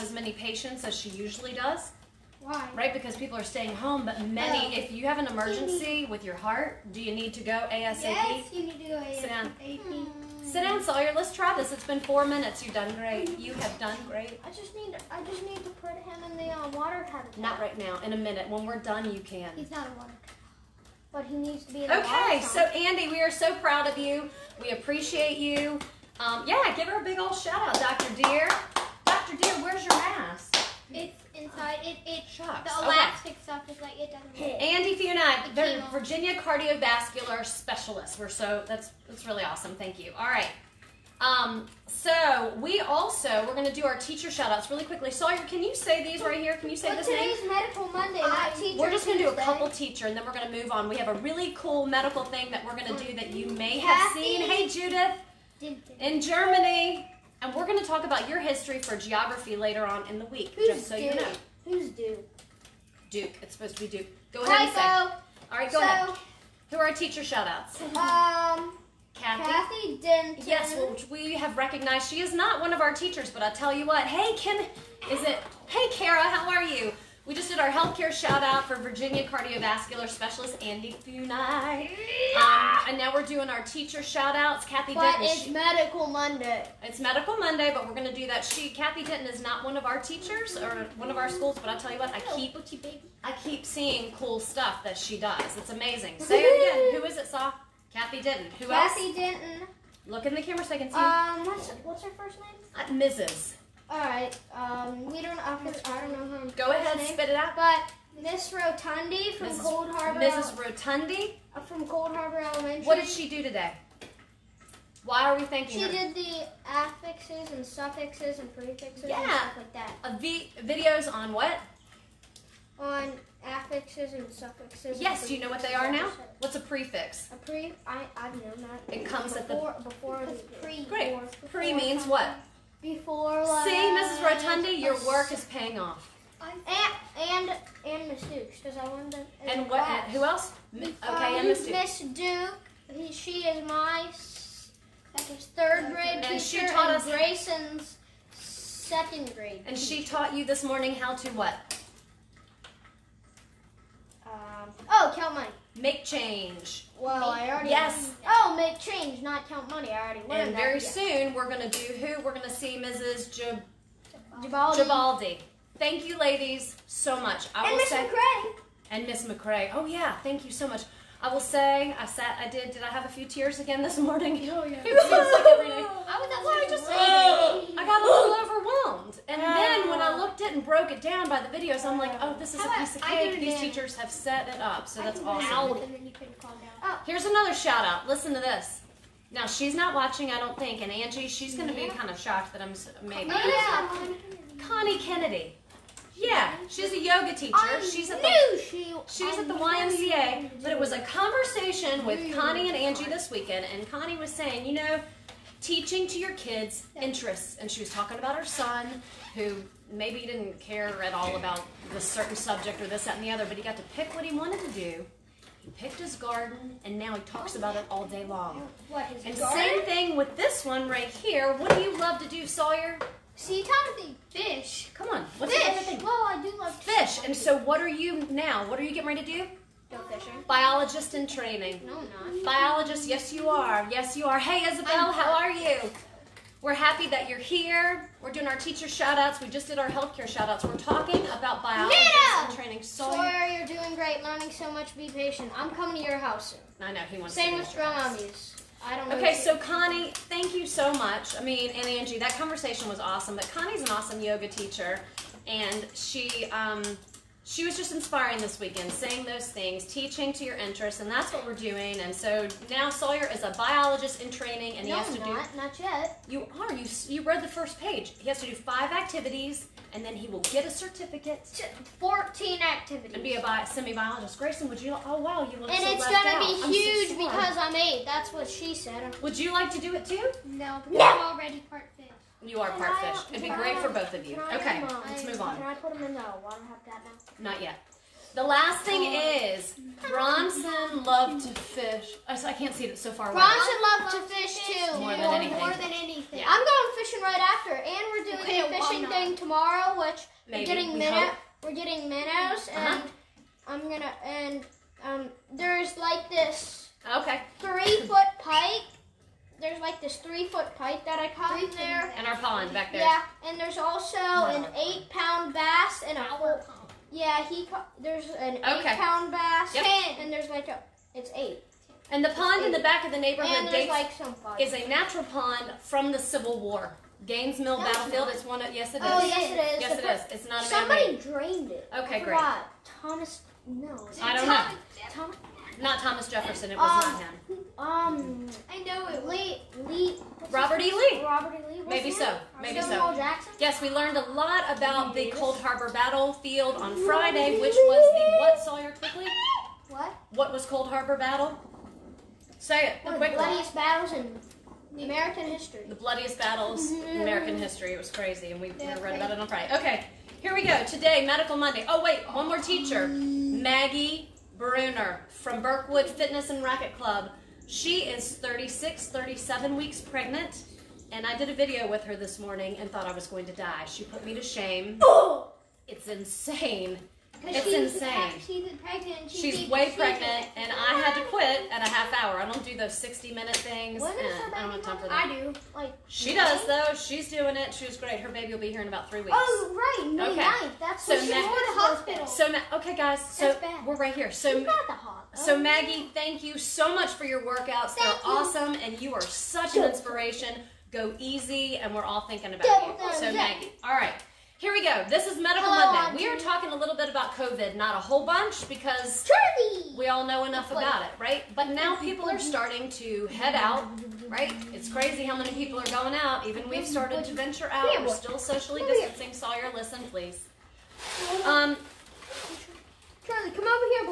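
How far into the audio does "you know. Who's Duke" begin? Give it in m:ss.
1:01.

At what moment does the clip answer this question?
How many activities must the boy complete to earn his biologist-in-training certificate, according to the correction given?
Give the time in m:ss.
4:31.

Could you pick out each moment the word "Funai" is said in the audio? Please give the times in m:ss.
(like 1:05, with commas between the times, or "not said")
0:34, 1:21.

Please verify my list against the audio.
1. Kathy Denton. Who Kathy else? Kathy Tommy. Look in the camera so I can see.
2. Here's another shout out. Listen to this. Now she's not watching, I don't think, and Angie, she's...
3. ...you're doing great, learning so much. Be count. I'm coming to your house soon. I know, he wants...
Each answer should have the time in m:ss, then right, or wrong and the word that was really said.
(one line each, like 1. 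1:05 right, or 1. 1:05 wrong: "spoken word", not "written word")
1. 1:37 wrong: "Denton", not "Tommy"
2. 3:07 right
3. 4:03 wrong: "patient", not "count".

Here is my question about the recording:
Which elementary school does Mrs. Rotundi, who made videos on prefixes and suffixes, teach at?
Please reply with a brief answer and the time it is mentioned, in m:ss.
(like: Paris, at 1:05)
Cold Harbor Elementary, at 1:51.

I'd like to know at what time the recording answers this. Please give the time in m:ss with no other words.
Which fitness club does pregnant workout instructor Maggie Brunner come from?
6:05.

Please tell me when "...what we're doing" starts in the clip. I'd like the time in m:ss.
4:21.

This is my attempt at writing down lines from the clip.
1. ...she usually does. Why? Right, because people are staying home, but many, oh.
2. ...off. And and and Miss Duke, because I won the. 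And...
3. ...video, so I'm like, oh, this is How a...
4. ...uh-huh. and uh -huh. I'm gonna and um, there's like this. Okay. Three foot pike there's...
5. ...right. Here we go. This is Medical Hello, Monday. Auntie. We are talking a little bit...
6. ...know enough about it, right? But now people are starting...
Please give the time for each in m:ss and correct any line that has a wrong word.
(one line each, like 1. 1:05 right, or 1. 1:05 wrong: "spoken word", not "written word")
1. 0:00 right
2. 2:15 right
3. 3:01 right
4. 5:02 right
5. 6:43 right
6. 6:50 right.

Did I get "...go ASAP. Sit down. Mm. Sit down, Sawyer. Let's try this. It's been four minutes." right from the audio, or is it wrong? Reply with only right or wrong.
right.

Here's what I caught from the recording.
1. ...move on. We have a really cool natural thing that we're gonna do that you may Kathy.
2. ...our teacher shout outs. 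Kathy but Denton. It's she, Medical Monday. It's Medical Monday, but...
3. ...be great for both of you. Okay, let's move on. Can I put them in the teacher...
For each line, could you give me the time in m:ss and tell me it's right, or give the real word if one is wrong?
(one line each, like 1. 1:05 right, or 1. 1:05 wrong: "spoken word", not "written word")
1. 0:50 wrong: "medical", not "natural"
2. 1:23 right
3. 4:43 wrong: "water", not "teacher".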